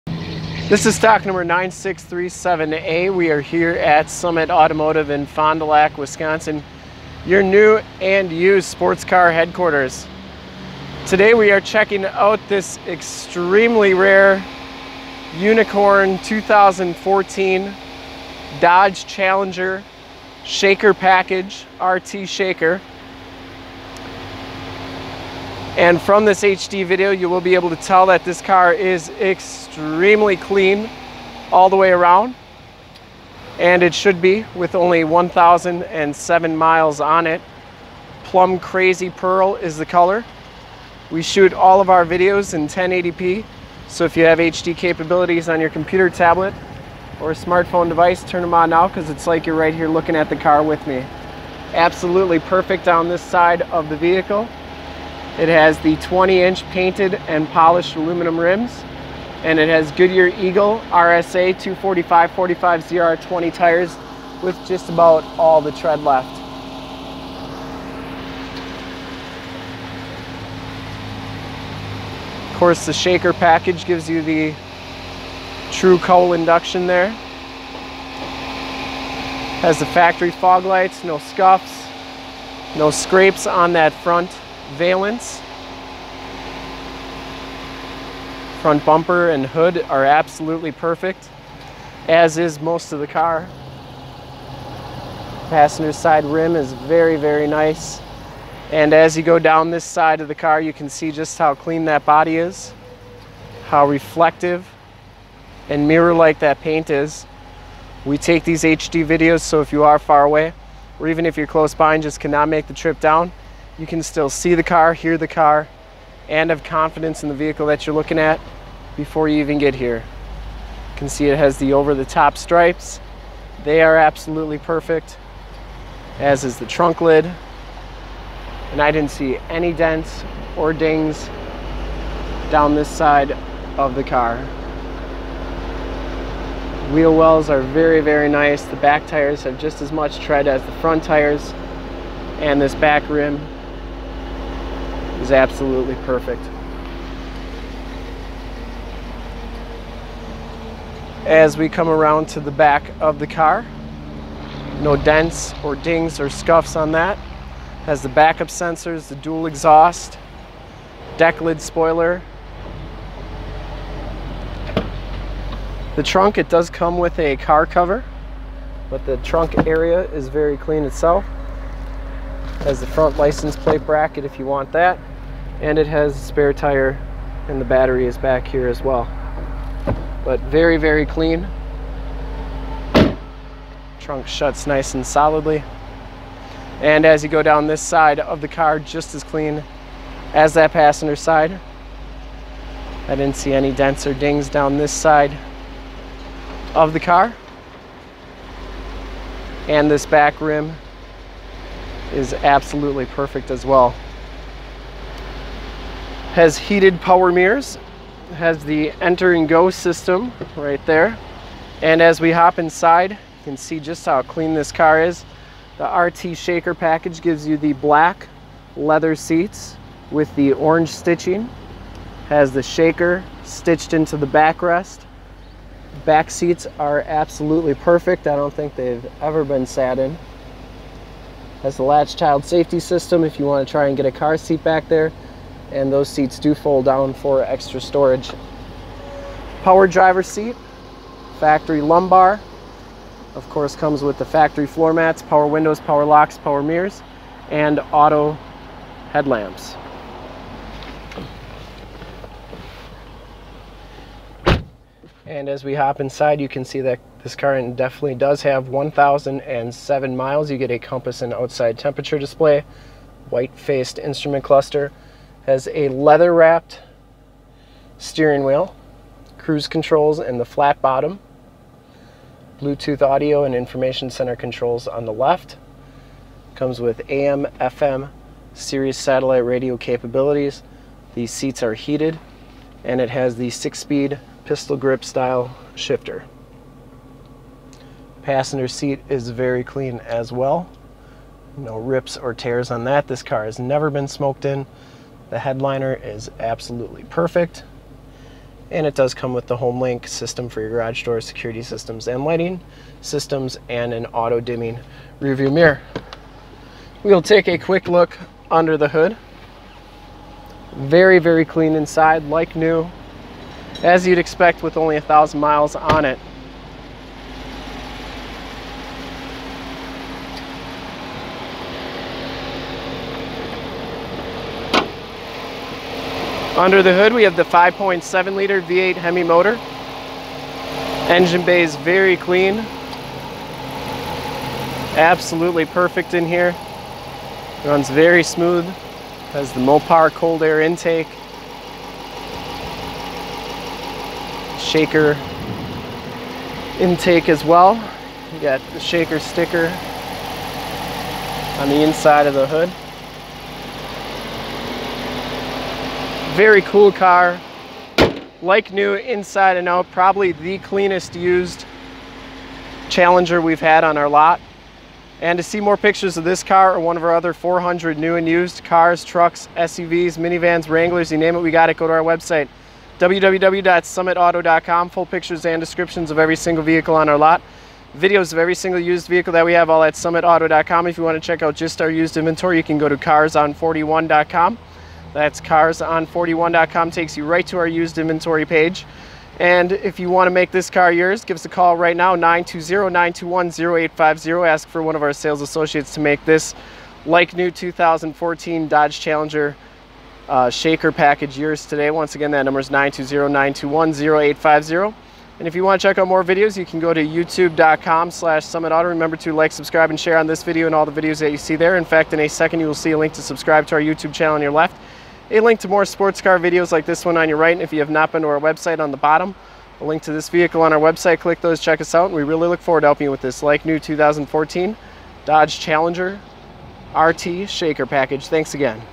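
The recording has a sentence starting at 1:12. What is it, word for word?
Of course the shaker package gives you the true cowl induction there.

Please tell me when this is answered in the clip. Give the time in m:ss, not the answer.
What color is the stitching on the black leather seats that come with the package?
3:40.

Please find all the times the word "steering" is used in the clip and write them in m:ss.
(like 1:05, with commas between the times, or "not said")
4:27.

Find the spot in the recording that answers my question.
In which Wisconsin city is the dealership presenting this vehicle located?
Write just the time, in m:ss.
0:05.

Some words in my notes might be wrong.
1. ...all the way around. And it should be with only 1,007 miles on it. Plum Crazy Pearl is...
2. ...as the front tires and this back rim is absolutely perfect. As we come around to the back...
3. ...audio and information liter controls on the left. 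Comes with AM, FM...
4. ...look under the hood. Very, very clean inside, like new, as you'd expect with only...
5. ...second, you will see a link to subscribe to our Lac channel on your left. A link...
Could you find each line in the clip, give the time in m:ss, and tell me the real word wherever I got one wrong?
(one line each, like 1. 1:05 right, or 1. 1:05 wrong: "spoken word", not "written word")
1. 0:31 right
2. 2:20 right
3. 4:33 wrong: "center", not "liter"
4. 5:07 right
5. 6:52 wrong: "YouTube", not "Lac".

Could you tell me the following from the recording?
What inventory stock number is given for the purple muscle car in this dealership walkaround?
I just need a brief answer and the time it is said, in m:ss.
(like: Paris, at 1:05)
9637A, at 0:01.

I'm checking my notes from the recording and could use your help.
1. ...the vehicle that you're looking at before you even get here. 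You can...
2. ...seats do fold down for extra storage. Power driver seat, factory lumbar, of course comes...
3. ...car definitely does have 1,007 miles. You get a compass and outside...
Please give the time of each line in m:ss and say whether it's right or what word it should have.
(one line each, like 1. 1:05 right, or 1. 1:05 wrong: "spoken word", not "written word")
1. 1:57 right
2. 3:56 right
3. 4:17 right.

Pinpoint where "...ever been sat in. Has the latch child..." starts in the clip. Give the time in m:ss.
3:49.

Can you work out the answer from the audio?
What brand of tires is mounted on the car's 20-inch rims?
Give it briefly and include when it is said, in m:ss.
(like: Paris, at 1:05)
Goodyear, at 0:59.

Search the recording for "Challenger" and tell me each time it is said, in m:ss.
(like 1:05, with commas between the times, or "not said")
0:19, 6:02, 6:38, 7:05.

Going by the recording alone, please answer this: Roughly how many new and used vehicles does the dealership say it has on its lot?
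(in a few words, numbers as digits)
400.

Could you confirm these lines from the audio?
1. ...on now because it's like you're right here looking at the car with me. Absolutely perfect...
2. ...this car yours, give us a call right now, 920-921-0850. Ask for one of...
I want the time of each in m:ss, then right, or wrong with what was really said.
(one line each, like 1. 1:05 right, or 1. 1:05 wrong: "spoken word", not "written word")
1. 0:48 right
2. 6:30 right.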